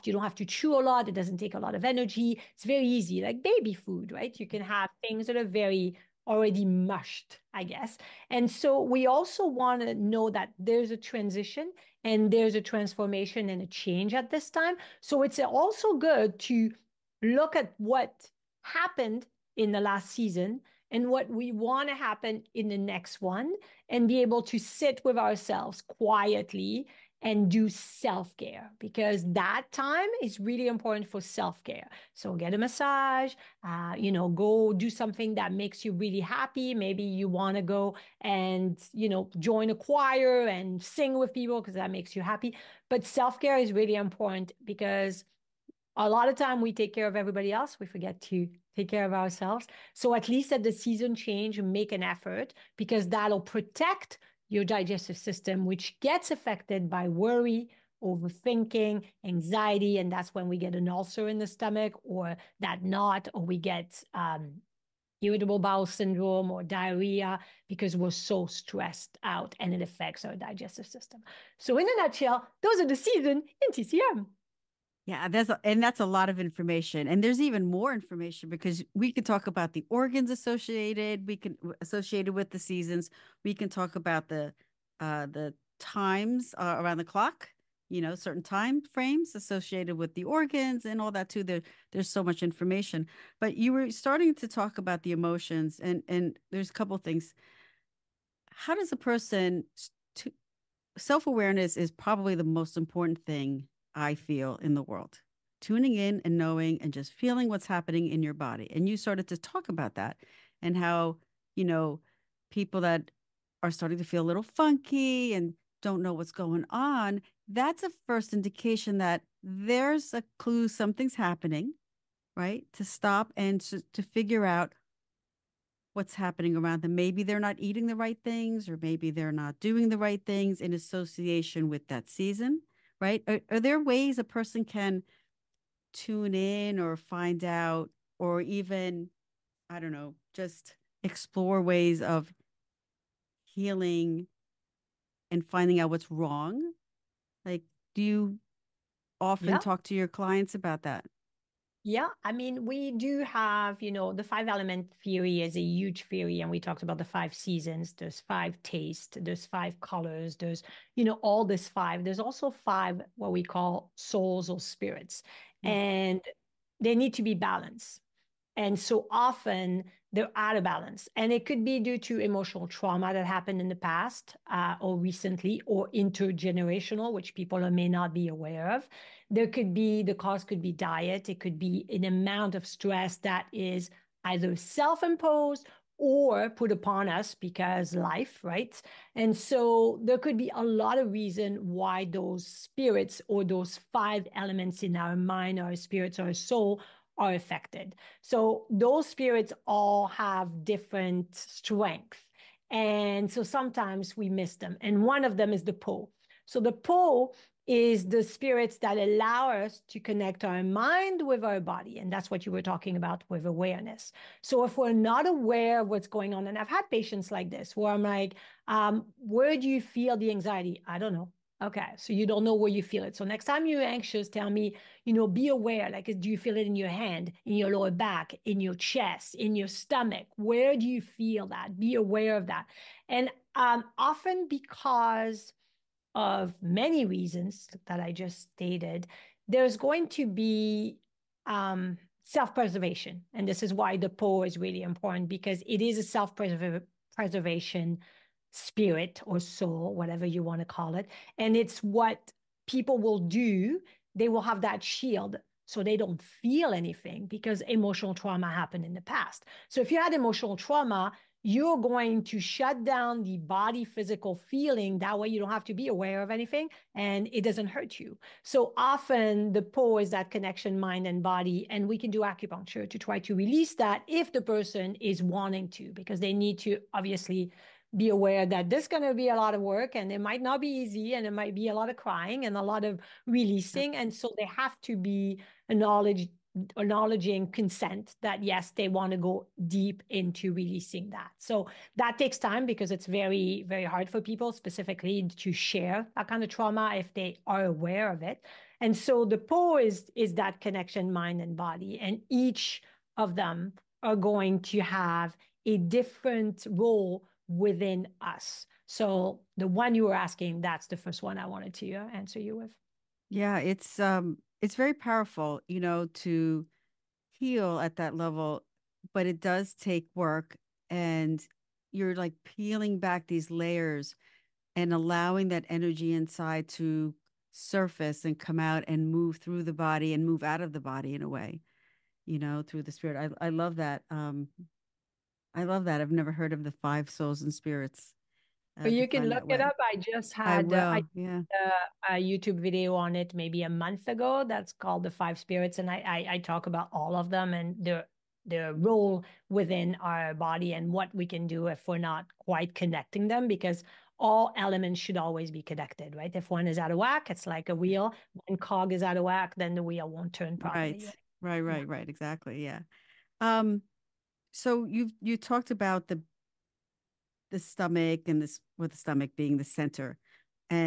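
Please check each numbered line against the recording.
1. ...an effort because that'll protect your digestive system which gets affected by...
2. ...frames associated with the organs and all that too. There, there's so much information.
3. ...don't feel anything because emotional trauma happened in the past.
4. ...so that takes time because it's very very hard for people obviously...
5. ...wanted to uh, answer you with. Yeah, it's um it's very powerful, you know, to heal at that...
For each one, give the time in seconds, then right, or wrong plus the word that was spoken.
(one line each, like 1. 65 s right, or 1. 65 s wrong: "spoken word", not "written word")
1. 51 s right
2. 88 s right
3. 255 s right
4. 291 s wrong: "specifically", not "obviously"
5. 311 s right.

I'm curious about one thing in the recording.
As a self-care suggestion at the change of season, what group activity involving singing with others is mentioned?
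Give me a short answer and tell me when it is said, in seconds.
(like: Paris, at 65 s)
join a choir, at 39 s.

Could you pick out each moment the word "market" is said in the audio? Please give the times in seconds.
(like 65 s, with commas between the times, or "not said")
not said.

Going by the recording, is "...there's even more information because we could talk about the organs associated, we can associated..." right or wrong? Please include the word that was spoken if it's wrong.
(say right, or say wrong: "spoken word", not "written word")
right.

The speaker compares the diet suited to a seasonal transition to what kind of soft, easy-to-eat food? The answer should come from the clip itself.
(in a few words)
baby food.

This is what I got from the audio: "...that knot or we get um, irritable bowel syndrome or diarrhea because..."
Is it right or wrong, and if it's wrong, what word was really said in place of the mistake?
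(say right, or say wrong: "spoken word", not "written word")
right.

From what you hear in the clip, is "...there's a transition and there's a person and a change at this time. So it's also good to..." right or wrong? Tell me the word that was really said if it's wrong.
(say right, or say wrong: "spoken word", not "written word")
wrong: "transformation", not "person".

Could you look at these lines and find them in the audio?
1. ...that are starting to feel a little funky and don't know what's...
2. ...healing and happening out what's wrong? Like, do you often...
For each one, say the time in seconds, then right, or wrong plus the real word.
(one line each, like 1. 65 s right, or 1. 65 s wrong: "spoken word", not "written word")
1. 112 s right
2. 143 s wrong: "finding", not "happening".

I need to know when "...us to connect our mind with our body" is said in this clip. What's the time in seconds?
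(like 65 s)
209 s.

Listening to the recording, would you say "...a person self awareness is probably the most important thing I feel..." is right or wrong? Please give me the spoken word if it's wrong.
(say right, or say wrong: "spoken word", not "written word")
right.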